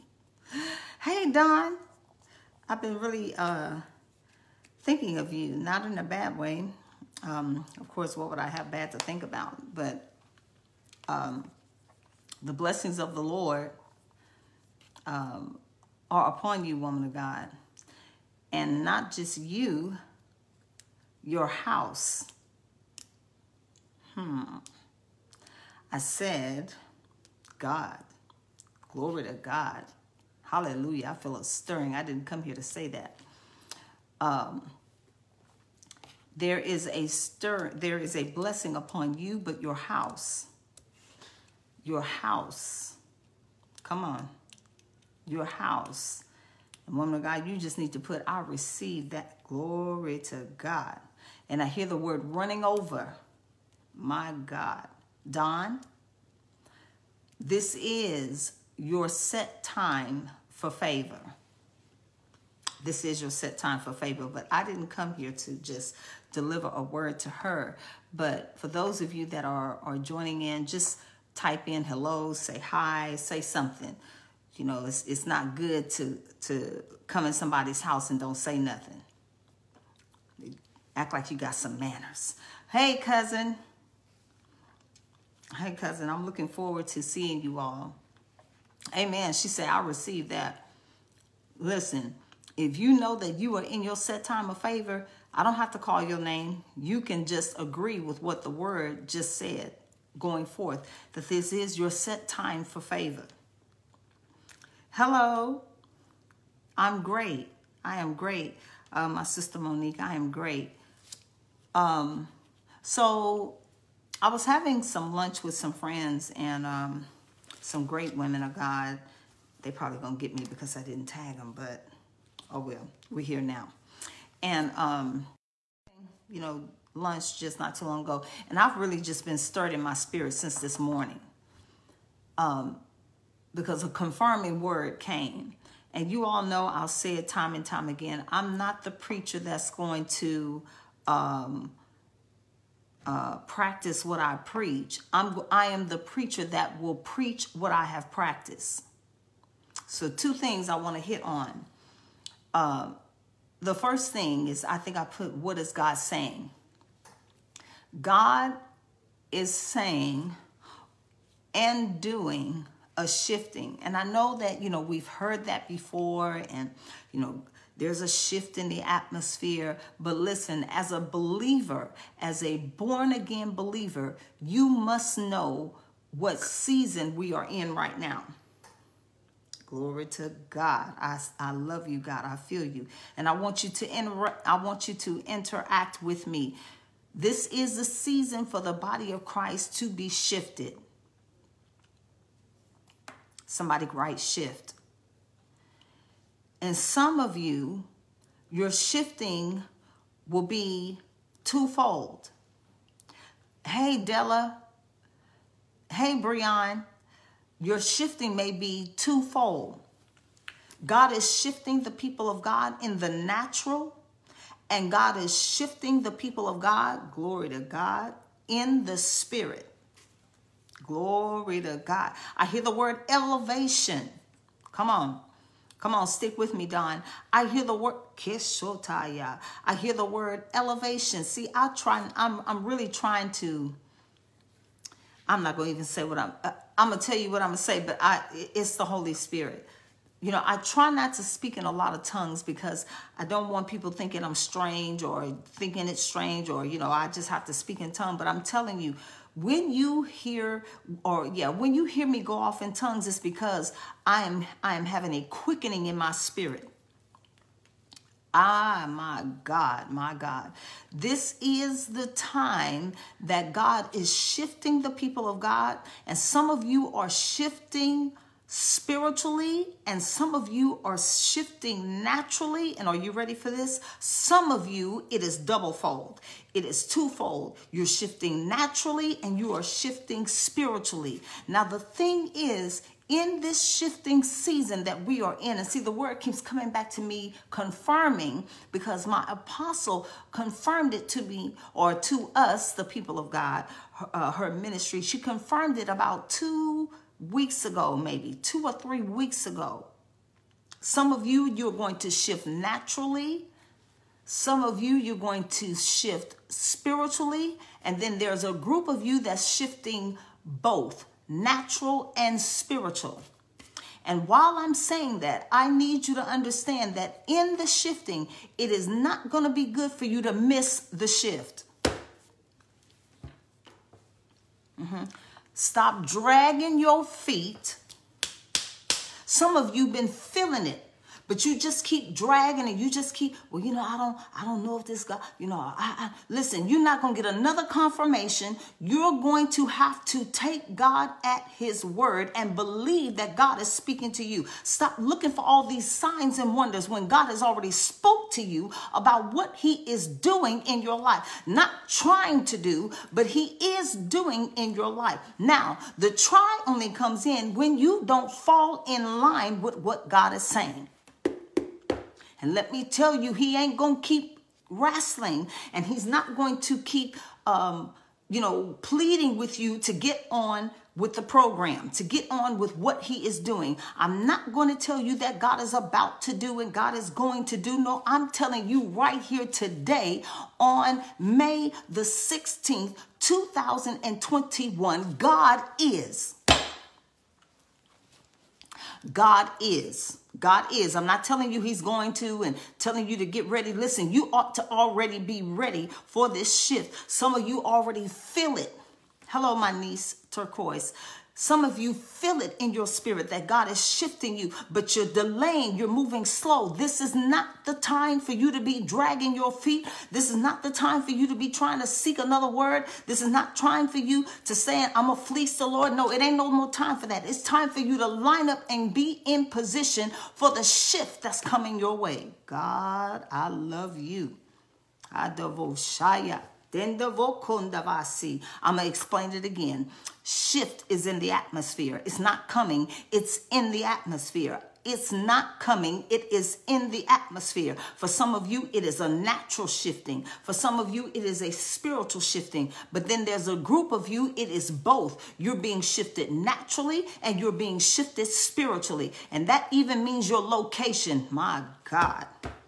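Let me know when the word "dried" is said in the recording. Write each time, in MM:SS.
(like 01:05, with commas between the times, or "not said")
not said.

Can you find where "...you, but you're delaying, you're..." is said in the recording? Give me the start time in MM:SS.
06:44.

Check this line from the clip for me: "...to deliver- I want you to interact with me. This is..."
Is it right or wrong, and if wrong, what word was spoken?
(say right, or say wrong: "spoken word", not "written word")
wrong: "inter", not "deliver".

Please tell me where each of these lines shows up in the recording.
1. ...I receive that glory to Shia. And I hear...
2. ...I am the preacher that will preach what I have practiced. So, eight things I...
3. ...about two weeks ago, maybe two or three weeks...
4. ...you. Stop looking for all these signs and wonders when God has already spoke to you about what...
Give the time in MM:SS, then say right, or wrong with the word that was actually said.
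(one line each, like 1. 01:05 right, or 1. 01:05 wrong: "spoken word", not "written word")
1. 00:48 wrong: "God", not "Shia"
2. 02:25 wrong: "two", not "eight"
3. 04:55 right
4. 05:44 right.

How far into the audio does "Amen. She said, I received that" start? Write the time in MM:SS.
01:28.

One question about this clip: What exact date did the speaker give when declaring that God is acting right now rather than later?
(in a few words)
May 16, 2021.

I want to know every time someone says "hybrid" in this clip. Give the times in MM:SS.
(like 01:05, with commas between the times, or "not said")
not said.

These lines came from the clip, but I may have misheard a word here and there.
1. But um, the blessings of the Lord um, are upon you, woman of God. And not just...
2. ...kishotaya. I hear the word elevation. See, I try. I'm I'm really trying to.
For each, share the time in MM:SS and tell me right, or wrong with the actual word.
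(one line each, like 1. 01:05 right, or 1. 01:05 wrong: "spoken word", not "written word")
1. 00:09 right
2. 03:48 right.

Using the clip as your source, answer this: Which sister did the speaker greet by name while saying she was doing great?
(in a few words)
Monique.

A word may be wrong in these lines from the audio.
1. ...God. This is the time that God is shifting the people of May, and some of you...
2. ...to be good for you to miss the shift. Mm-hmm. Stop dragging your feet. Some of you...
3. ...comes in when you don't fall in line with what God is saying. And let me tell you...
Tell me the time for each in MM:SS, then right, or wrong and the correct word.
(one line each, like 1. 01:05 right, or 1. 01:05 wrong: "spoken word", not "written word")
1. 04:20 wrong: "God", not "May"
2. 05:19 right
3. 05:56 right.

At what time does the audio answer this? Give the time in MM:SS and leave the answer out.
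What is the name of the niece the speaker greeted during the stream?
06:40.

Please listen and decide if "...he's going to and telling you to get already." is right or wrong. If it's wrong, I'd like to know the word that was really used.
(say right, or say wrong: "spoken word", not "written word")
wrong: "ready", not "already".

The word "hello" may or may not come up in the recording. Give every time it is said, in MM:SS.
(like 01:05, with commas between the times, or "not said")
01:11, 01:44, 06:39.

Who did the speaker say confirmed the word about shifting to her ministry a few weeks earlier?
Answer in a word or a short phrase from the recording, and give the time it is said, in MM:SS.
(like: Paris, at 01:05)
my apostle, at 04:49.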